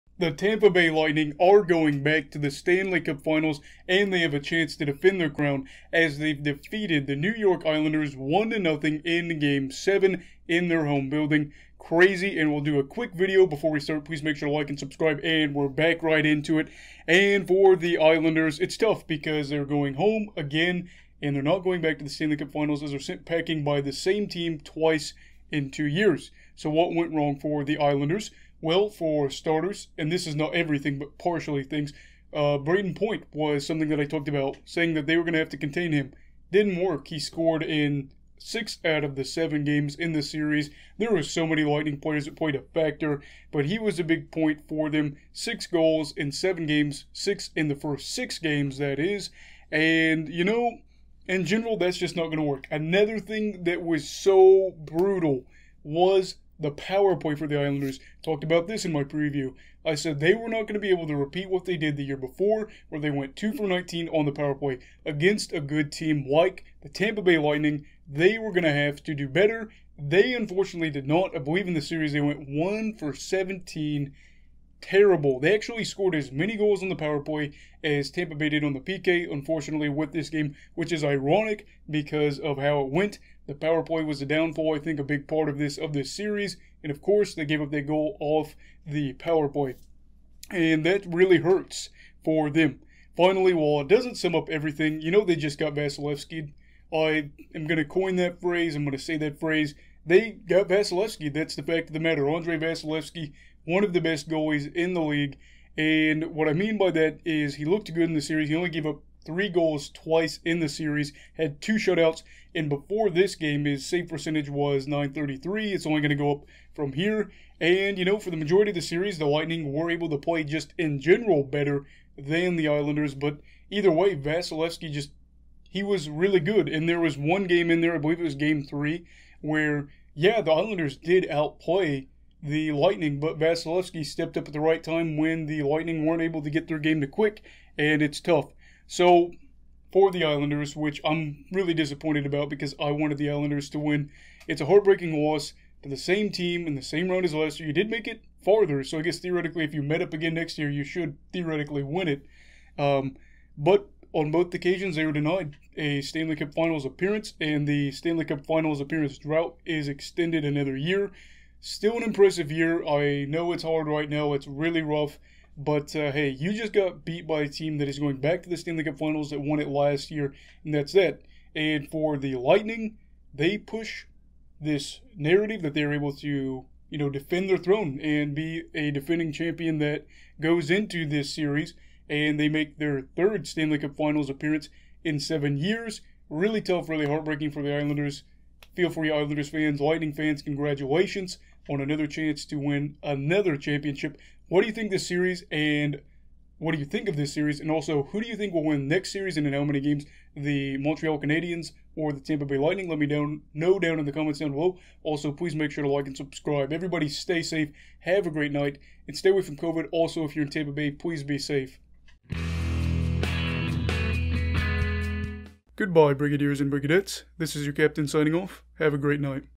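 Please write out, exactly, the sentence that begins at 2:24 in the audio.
It's a heartbreaking loss to the same team in the same round as last year.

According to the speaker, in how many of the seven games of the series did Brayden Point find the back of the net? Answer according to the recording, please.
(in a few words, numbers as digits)
6.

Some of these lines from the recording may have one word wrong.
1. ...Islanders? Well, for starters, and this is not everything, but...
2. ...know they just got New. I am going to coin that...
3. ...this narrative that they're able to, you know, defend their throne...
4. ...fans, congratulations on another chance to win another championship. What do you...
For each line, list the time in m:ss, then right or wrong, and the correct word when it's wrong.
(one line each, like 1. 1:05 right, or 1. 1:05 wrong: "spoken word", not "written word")
1. 0:27 right
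2. 1:35 wrong: "Vasilevskiy", not "New"
3. 2:54 right
4. 3:10 right.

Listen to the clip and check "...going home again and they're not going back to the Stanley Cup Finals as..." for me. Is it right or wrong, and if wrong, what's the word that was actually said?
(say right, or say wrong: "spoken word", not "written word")
right.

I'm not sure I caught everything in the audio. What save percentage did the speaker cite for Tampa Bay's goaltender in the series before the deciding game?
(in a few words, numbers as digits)
933.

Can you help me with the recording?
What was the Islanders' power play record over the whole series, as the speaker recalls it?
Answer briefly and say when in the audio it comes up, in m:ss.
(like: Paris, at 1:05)
1 for 17, at 1:12.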